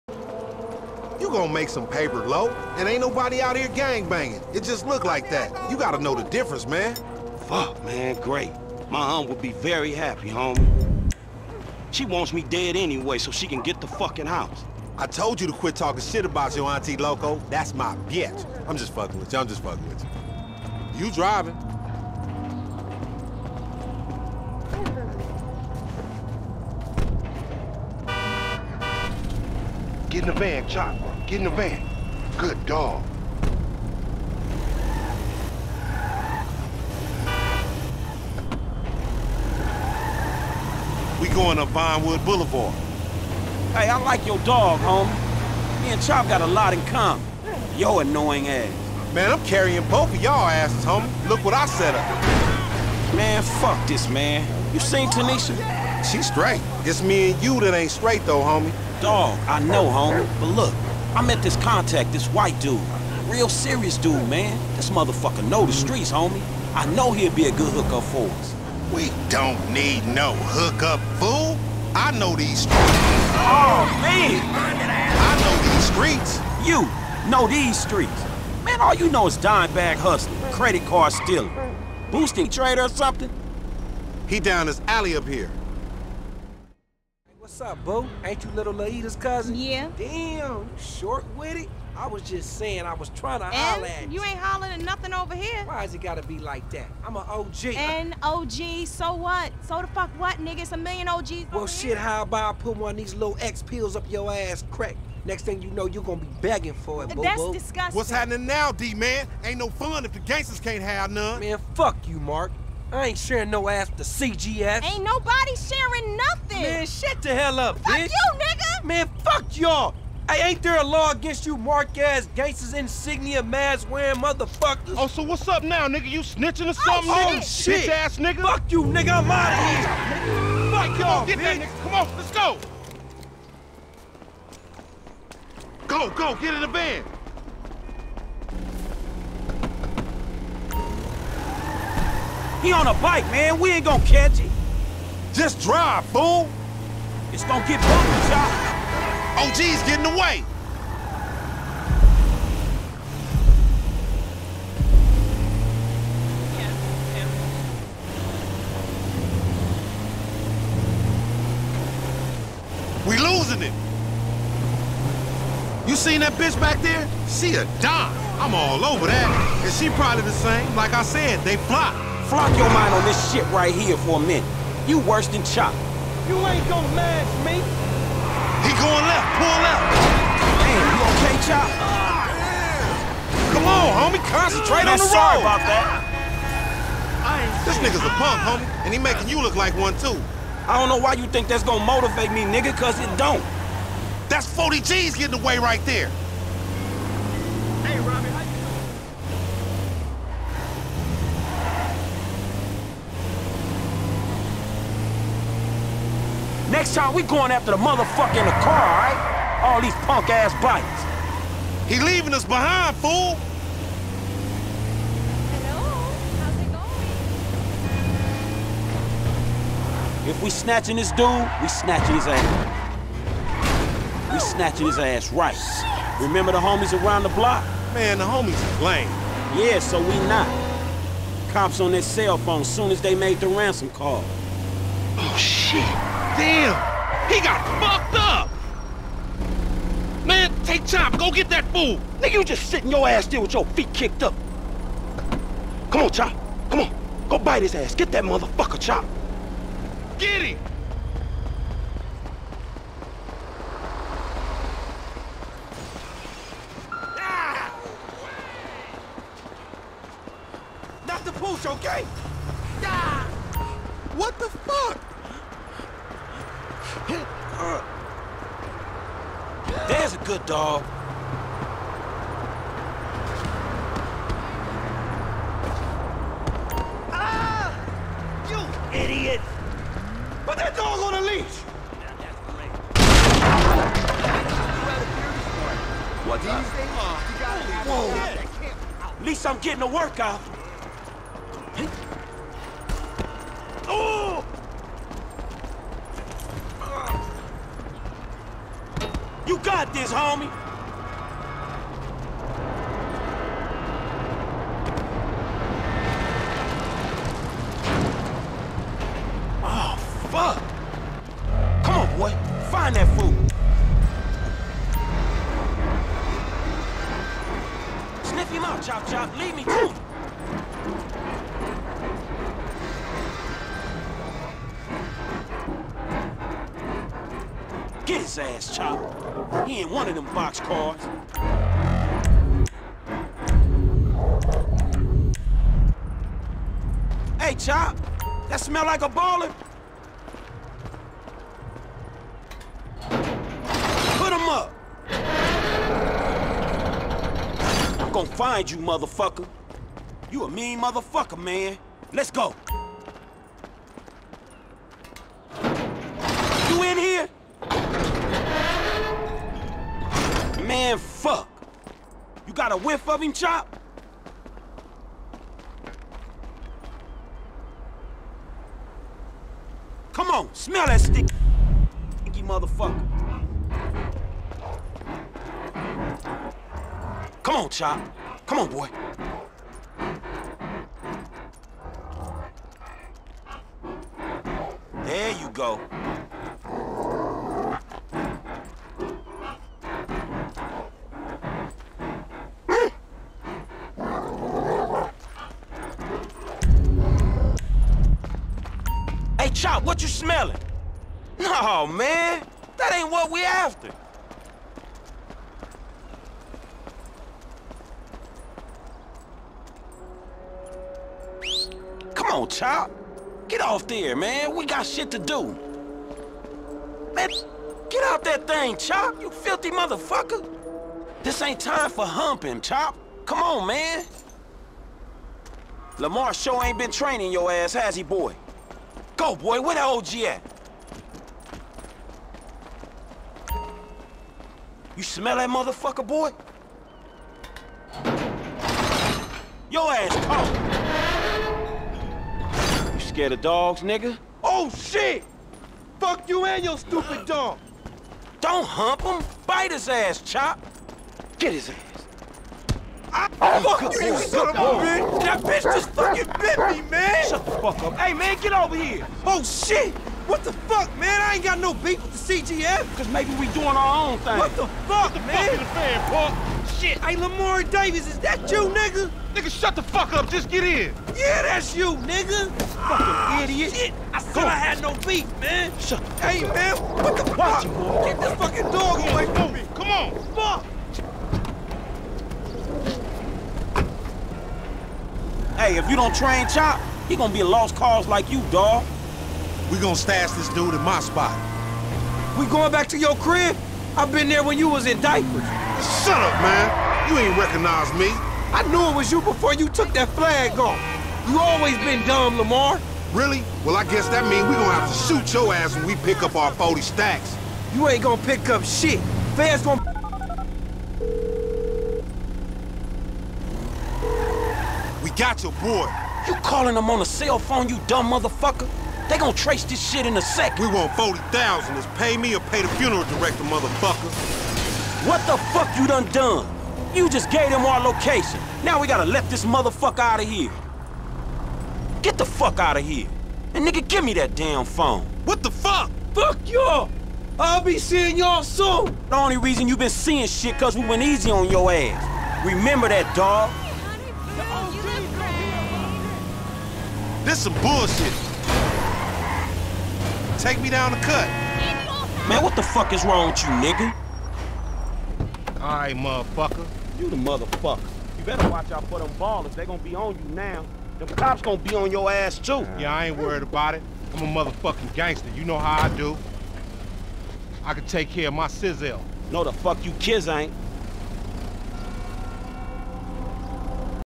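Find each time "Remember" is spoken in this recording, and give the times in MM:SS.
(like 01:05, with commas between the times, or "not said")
03:46, 09:02.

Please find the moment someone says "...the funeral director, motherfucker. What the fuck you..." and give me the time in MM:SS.
08:42.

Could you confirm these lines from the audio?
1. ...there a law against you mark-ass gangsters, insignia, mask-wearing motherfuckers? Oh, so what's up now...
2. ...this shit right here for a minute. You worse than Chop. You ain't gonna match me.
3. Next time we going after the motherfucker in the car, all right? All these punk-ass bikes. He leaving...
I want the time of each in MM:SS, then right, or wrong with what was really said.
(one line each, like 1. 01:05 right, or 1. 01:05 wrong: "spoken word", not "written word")
1. 02:00 right
2. 02:53 right
3. 03:26 right.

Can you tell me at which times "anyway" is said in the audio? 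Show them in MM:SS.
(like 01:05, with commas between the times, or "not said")
00:12.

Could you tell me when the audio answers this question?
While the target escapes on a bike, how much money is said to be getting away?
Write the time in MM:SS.
03:14.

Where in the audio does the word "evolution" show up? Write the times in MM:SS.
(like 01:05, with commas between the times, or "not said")
not said.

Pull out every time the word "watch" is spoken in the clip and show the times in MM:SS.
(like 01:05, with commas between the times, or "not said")
07:57, 09:18.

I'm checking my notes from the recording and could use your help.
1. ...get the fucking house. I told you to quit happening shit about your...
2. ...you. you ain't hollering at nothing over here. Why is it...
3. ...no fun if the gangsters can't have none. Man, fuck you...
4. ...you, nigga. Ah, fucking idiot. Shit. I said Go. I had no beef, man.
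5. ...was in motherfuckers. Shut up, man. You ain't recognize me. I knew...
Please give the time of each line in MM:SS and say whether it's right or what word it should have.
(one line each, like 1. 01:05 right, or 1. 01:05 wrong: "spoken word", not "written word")
1. 00:13 wrong: "talking", not "happening"
2. 01:34 right
3. 01:49 right
4. 07:51 right
5. 08:14 wrong: "diapers", not "motherfuckers".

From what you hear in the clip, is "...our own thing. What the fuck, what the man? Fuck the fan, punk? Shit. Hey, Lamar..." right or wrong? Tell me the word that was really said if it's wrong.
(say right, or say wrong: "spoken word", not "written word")
right.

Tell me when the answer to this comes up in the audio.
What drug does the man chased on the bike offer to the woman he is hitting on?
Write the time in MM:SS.
01:43.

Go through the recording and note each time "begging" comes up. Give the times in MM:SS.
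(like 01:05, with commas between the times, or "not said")
01:46.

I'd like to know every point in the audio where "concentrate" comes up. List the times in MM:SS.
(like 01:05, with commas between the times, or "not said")
03:04.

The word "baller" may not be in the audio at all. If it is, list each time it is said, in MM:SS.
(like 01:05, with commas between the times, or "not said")
05:39, 09:19.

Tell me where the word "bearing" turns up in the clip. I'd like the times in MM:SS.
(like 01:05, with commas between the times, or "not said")
not said.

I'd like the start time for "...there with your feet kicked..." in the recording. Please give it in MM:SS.
04:03.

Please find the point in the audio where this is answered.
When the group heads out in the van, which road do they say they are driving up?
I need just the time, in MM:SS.
00:41.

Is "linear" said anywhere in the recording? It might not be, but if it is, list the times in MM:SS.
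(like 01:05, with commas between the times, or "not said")
not said.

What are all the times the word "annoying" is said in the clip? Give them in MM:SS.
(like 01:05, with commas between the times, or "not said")
00:47.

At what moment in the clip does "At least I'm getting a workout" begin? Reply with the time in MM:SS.
04:49.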